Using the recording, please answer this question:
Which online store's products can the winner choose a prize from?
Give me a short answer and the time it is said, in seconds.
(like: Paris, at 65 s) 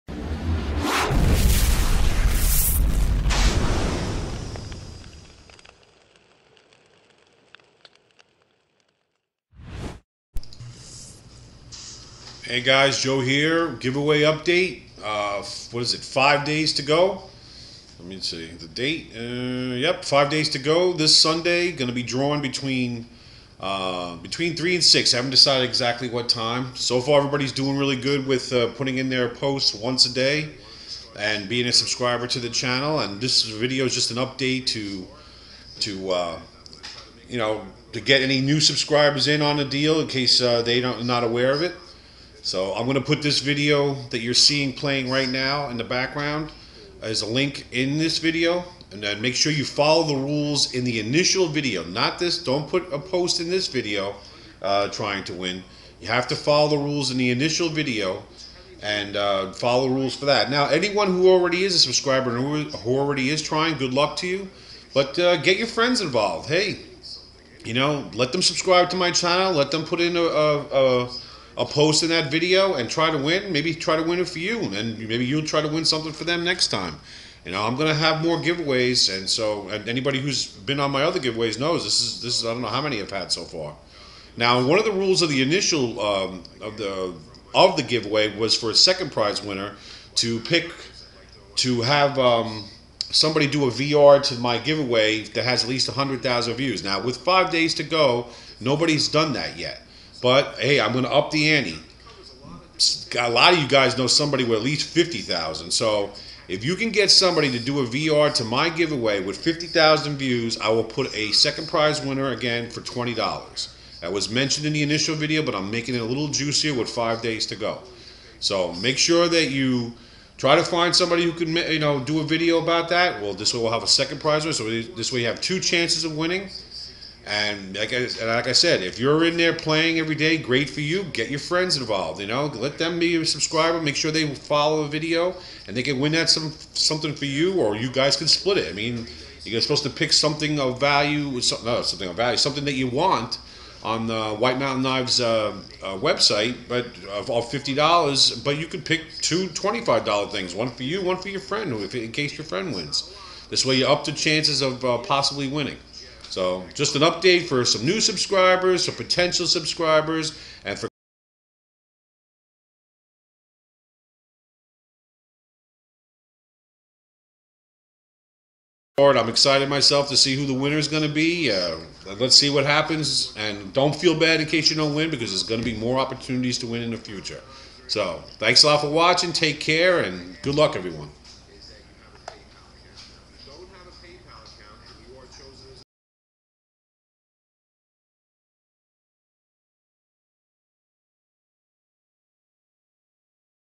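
White Mountain Knives, at 144 s.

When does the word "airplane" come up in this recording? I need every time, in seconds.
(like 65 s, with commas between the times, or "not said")
not said.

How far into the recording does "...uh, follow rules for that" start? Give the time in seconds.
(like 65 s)
59 s.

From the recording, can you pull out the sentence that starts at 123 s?
Well, this way we'll have a second prize winner.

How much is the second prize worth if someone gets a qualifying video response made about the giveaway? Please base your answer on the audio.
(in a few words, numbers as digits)
$20.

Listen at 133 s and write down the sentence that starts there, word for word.
Make sure they follow the video, and they can win that some something for you, or you guys can split it.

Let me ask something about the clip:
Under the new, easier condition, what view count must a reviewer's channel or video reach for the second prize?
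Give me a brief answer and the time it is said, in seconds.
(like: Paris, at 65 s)
50,000, at 109 s.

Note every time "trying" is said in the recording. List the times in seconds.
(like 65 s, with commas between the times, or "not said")
54 s, 63 s.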